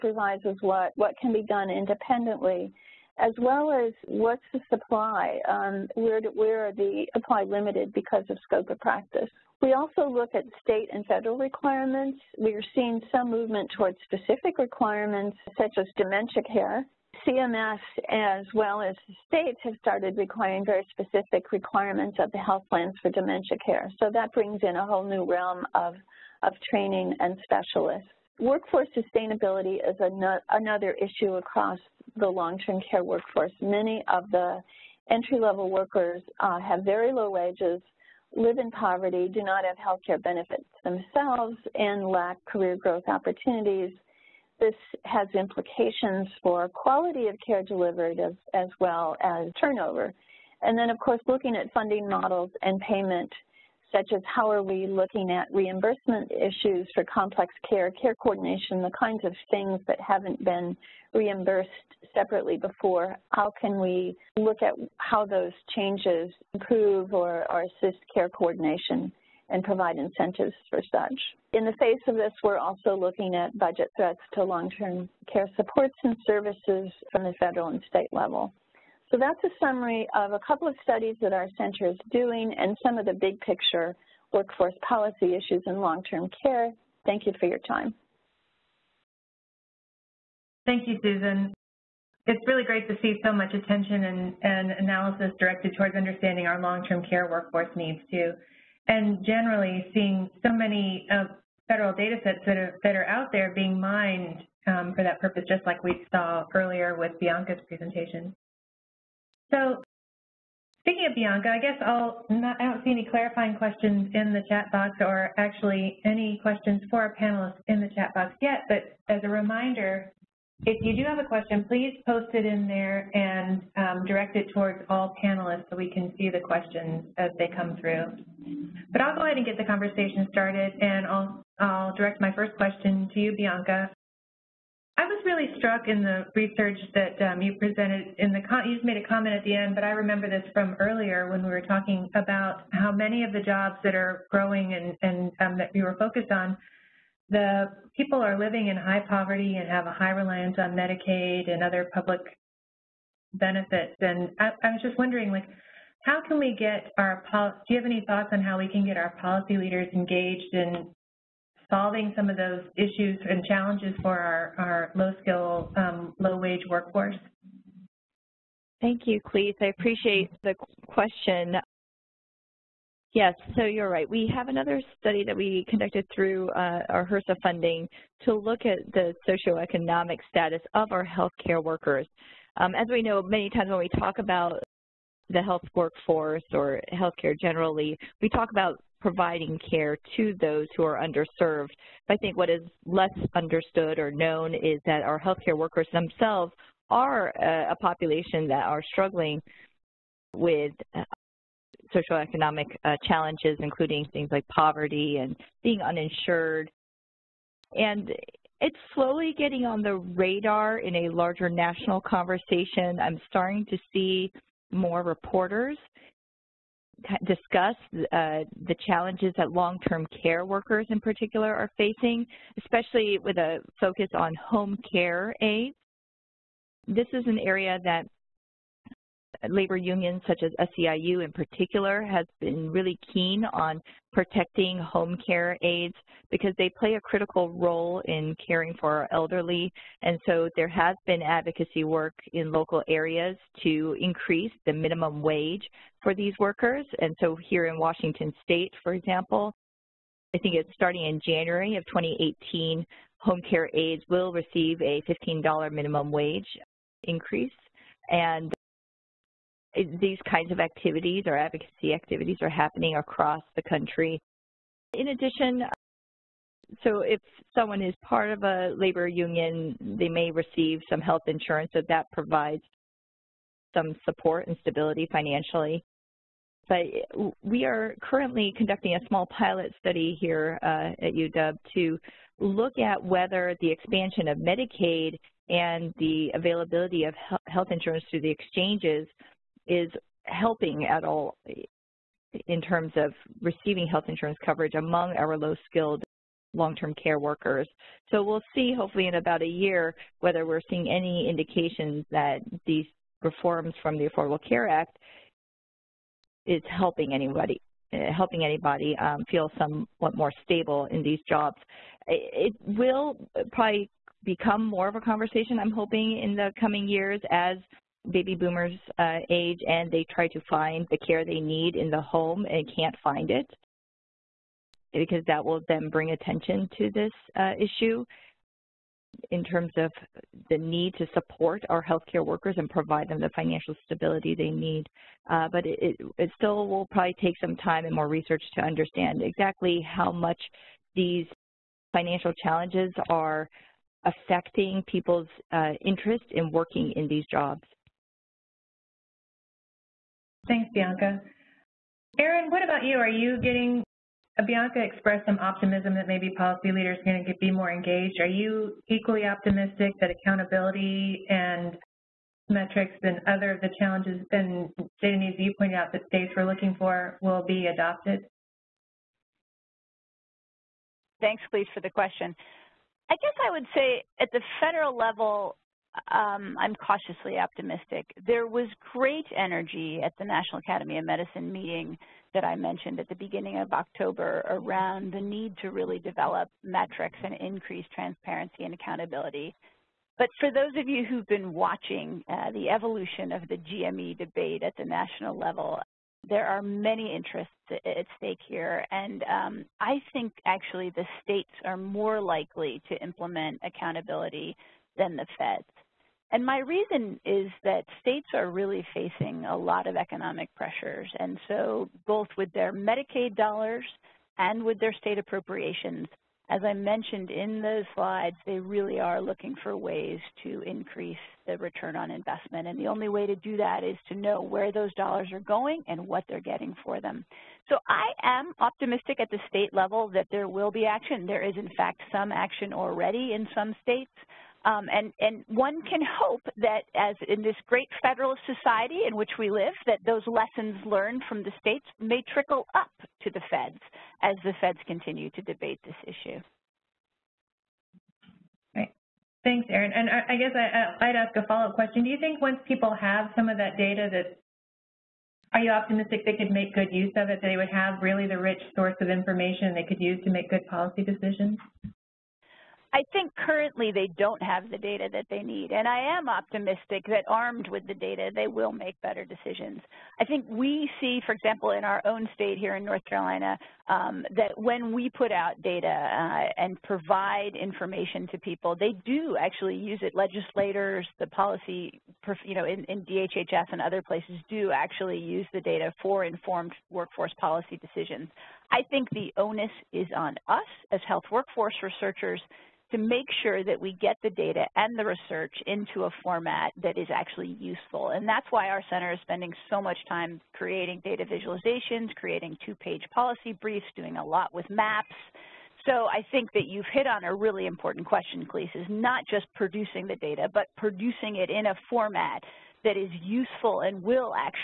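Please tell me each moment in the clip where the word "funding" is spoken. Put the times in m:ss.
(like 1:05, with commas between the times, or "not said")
0:51, 2:57.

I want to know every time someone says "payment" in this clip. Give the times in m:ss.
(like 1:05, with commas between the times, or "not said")
0:52.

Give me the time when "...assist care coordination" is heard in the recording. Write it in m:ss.
1:07.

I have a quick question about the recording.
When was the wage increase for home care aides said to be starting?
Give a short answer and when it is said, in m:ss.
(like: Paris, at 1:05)
January 2018, at 4:11.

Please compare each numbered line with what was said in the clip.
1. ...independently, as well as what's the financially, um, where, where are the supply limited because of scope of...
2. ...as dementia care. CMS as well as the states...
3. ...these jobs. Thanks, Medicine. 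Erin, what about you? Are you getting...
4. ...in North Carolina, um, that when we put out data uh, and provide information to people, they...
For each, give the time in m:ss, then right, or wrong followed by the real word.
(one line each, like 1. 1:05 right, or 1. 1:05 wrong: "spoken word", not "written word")
1. 0:01 wrong: "supply", not "financially"
2. 0:15 right
3. 5:47 wrong: "Bianca", not "Medicine"
4. 7:52 right.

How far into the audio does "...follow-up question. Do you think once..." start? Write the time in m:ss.
7:31.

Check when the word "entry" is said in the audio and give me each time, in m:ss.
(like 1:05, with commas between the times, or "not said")
0:35.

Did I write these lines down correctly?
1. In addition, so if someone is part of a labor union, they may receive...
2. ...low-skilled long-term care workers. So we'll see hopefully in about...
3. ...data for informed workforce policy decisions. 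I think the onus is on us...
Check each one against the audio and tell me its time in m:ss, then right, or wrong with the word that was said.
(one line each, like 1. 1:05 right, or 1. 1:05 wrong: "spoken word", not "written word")
1. 4:24 right
2. 4:55 right
3. 8:05 right.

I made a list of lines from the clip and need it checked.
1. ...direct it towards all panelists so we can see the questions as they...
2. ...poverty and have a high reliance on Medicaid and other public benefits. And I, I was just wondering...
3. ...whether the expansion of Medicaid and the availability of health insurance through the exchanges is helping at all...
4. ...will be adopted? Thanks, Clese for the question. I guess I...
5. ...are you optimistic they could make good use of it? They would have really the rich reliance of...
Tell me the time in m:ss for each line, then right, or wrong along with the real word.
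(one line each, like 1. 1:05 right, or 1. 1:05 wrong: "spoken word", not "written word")
1. 2:04 right
2. 2:29 right
3. 4:43 right
4. 6:07 right
5. 7:35 wrong: "source", not "reliance".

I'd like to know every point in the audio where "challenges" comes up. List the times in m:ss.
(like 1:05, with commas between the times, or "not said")
2:43, 3:23, 3:38, 5:42, 6:03.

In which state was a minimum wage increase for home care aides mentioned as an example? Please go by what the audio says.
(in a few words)
Washington.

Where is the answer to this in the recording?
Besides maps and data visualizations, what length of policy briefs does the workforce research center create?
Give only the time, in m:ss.
8:22.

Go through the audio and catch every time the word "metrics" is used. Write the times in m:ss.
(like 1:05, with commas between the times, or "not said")
6:02, 6:26.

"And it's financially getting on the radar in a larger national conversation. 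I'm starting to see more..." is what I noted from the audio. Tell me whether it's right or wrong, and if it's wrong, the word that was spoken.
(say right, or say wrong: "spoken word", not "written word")
wrong: "slowly", not "financially".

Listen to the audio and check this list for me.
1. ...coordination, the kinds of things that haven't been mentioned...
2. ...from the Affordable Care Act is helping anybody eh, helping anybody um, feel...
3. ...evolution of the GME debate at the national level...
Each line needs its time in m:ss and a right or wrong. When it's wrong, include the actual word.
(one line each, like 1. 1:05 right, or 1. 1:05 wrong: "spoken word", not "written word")
1. 0:58 wrong: "reimbursed", not "mentioned"
2. 5:03 right
3. 6:32 right.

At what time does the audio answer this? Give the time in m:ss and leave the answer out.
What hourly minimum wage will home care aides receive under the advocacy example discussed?
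4:15.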